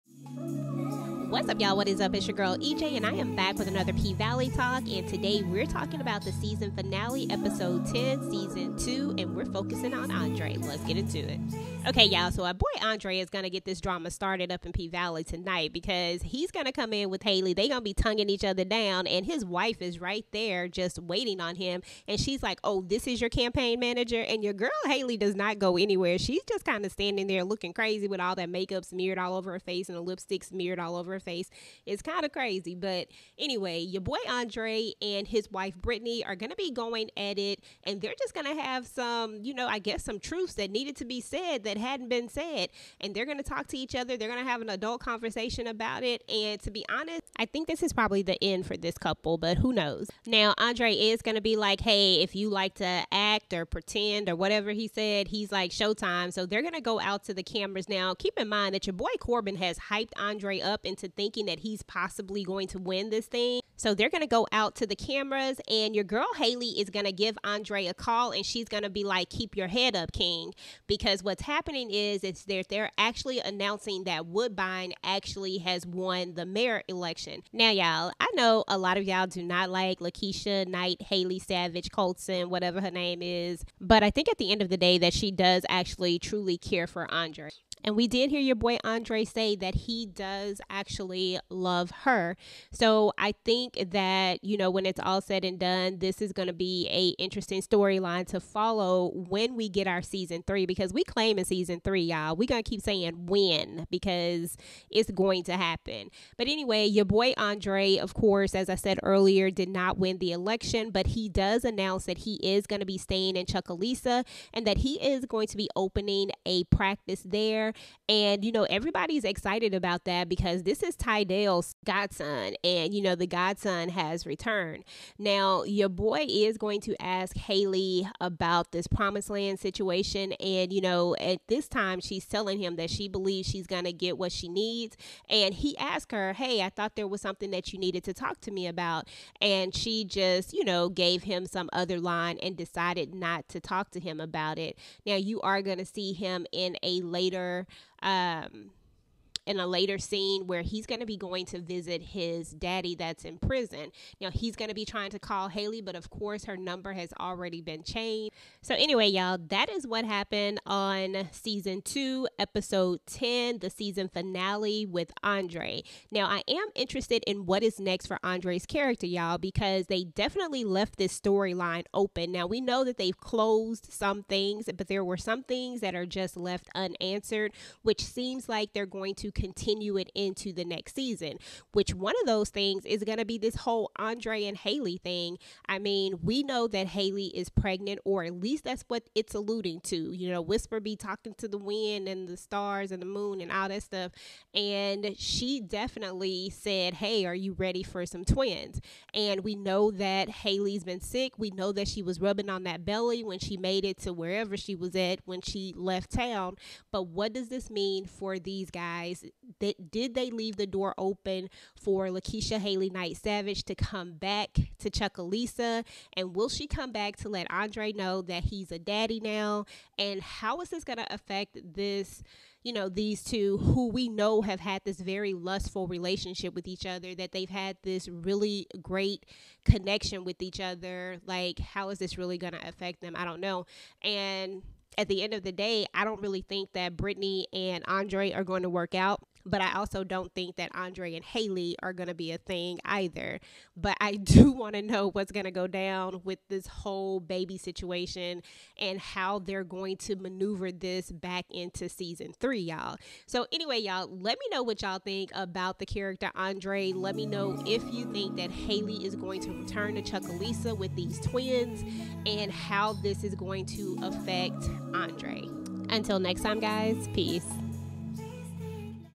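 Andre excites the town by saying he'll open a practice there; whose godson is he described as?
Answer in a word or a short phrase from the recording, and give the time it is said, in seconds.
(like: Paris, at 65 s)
Ty Dale, at 120 s.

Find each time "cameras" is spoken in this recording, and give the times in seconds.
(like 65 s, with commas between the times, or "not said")
57 s, 64 s.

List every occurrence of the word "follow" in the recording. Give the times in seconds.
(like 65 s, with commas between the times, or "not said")
98 s.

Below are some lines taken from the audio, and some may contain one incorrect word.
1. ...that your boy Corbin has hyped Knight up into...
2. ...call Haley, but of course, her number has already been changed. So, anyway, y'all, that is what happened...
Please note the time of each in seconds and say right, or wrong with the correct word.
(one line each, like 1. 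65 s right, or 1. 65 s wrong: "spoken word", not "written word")
1. 58 s wrong: "Andre", not "Knight"
2. 155 s right.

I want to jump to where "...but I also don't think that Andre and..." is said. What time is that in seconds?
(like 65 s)
239 s.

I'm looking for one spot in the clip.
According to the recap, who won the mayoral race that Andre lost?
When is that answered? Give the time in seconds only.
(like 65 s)
74 s.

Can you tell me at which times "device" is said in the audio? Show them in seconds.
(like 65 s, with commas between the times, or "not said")
not said.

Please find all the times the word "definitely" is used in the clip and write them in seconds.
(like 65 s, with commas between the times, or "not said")
170 s, 195 s.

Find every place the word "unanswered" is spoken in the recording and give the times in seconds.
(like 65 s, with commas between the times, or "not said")
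176 s.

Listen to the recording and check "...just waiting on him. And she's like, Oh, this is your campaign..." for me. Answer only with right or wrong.
right.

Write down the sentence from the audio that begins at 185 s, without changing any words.
I mean, we know that Haley is pregnant, or at least that's what it's alluding to.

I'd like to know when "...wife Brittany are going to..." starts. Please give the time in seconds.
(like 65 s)
35 s.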